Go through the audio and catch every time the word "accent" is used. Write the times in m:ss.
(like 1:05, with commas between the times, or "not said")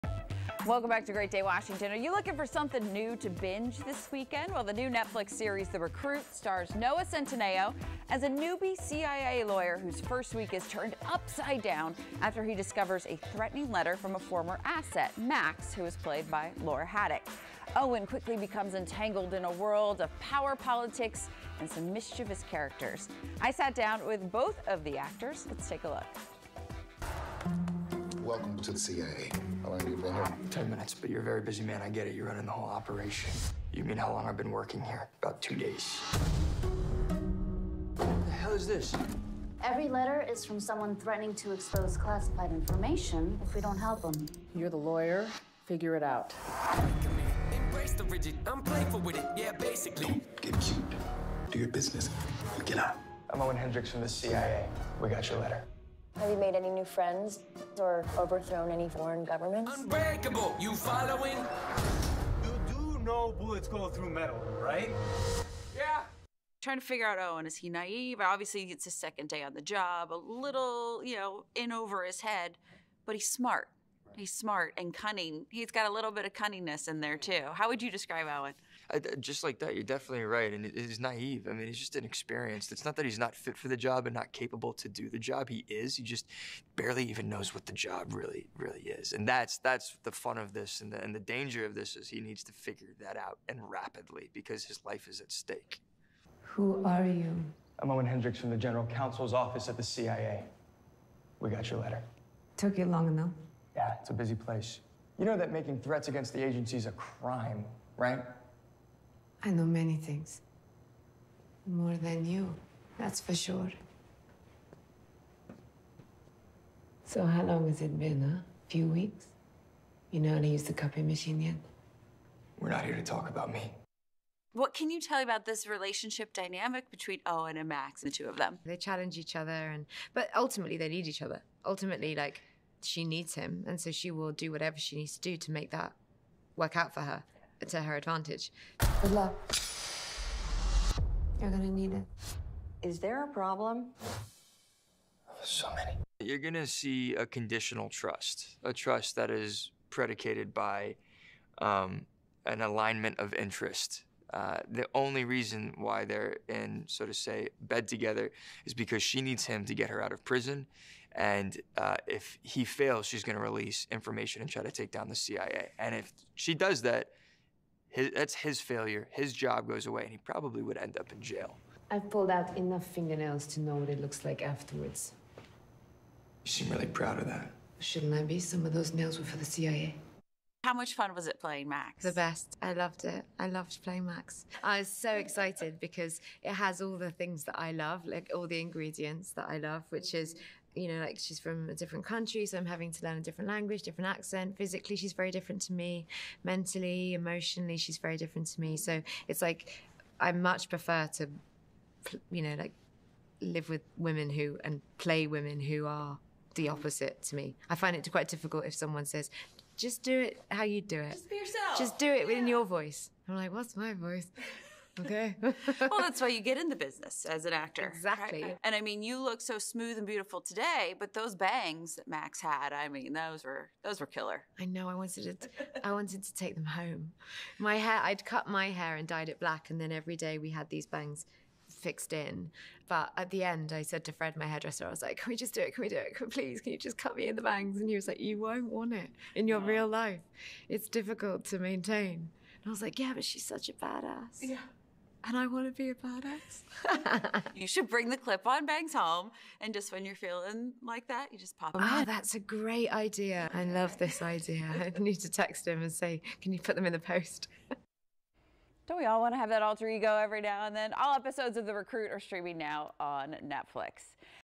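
3:14.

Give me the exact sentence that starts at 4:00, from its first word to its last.
It's difficult to maintain." And I was like, "Yeah, but she's such a badass." Yeah and I want to be a badass.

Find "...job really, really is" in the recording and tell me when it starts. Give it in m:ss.
1:27.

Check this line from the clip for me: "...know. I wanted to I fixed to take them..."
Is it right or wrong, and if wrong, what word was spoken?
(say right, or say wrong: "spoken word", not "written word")
wrong: "wanted", not "fixed".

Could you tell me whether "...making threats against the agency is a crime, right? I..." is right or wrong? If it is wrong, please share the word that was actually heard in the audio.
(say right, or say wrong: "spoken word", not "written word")
right.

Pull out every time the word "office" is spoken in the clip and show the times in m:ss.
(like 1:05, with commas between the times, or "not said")
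1:39.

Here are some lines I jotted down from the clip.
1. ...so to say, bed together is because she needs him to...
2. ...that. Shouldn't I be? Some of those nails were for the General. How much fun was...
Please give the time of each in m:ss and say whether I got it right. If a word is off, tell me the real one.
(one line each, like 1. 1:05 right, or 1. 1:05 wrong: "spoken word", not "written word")
1. 2:36 right
2. 2:57 wrong: "CIA", not "General".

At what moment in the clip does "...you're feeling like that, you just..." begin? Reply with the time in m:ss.
4:10.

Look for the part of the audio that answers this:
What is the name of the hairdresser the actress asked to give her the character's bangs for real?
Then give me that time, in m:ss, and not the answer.
3:54.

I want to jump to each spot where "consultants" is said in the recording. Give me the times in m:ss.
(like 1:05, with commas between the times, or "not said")
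not said.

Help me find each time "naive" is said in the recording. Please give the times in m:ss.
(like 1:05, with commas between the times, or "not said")
1:07, 1:20.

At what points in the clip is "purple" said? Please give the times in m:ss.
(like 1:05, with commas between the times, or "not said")
not said.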